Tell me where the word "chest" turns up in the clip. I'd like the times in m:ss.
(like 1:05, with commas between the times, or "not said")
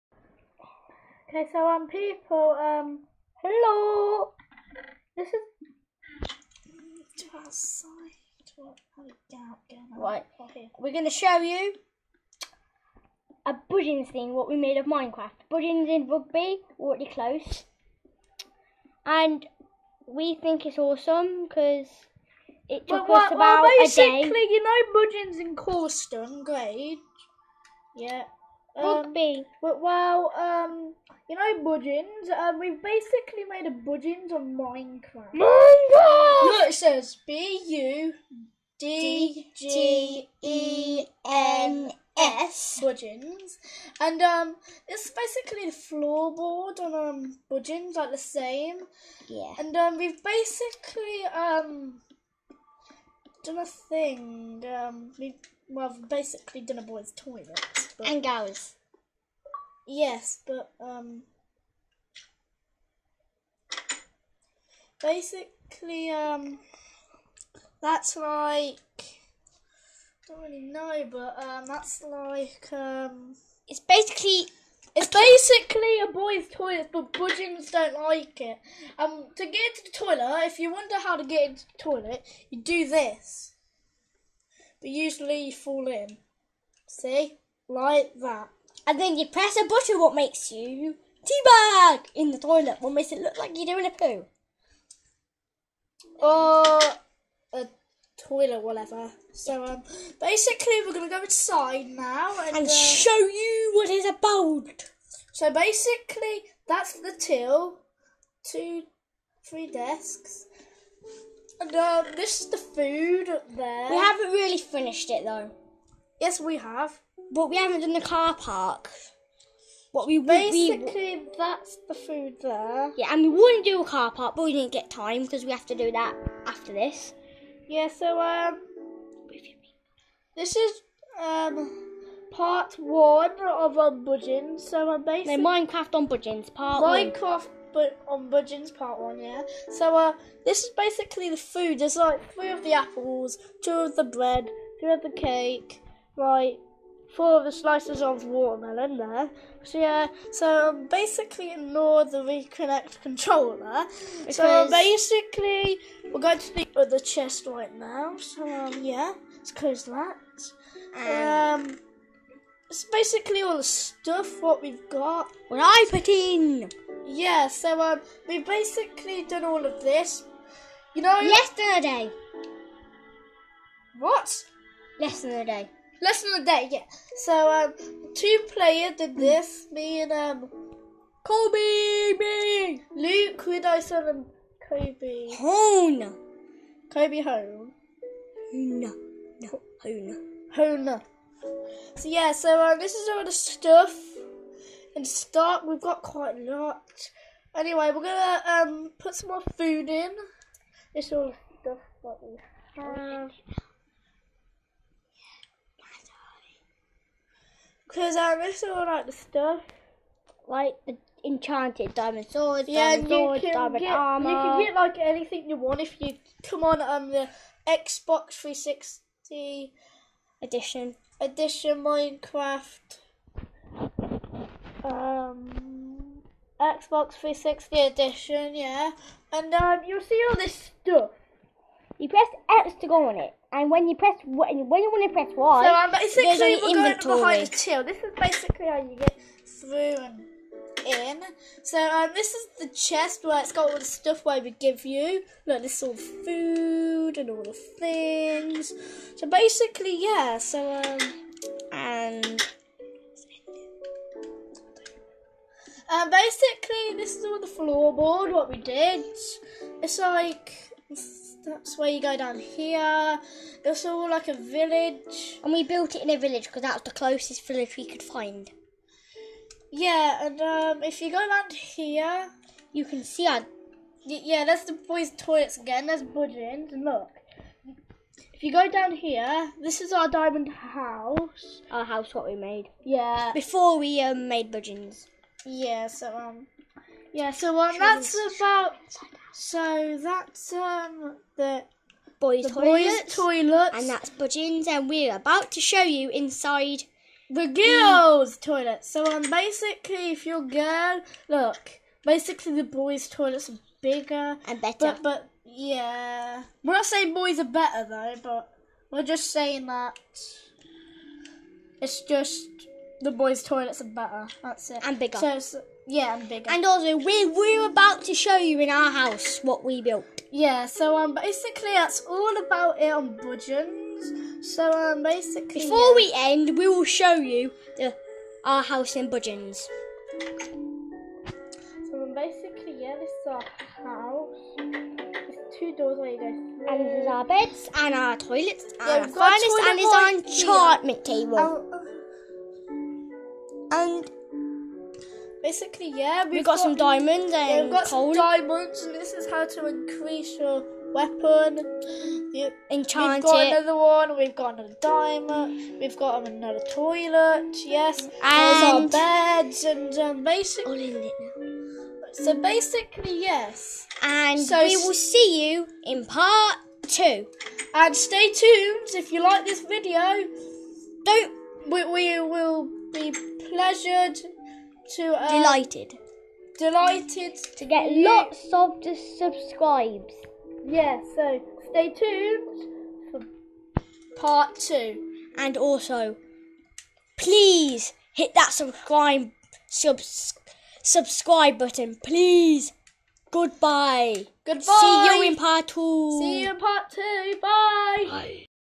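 2:36, 4:02.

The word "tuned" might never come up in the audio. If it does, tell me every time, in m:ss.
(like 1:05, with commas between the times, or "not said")
6:08, 6:21.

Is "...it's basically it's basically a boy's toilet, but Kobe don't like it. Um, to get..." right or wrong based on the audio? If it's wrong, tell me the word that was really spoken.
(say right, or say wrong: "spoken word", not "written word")
wrong: "Budgens", not "Kobe".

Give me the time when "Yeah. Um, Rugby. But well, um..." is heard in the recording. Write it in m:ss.
0:27.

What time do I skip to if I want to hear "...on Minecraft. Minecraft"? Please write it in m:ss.
0:34.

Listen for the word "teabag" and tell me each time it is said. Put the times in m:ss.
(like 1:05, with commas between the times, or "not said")
1:31.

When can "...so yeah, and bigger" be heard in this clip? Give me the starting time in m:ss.
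5:15.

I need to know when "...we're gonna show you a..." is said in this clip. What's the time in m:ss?
0:10.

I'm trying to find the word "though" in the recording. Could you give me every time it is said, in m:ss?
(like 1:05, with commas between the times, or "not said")
1:55, 5:07.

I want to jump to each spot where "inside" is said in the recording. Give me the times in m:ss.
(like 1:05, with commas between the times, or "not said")
1:41, 4:56.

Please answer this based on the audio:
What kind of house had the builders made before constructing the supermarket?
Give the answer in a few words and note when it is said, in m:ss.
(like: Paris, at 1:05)
diamond house, at 4:40.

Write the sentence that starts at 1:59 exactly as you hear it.
What we basically we, that's the food there.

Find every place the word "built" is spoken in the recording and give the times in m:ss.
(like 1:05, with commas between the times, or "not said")
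4:25, 5:19.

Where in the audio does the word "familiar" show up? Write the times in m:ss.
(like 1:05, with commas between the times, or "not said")
not said.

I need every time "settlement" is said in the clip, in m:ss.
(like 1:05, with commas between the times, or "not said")
not said.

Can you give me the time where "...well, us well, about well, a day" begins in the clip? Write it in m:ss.
0:23.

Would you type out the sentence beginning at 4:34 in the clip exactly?
Yeah, that's the boys' toilets again.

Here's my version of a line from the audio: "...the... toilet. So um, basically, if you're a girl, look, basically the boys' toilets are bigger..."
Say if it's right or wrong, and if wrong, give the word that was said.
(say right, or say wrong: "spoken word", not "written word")
right.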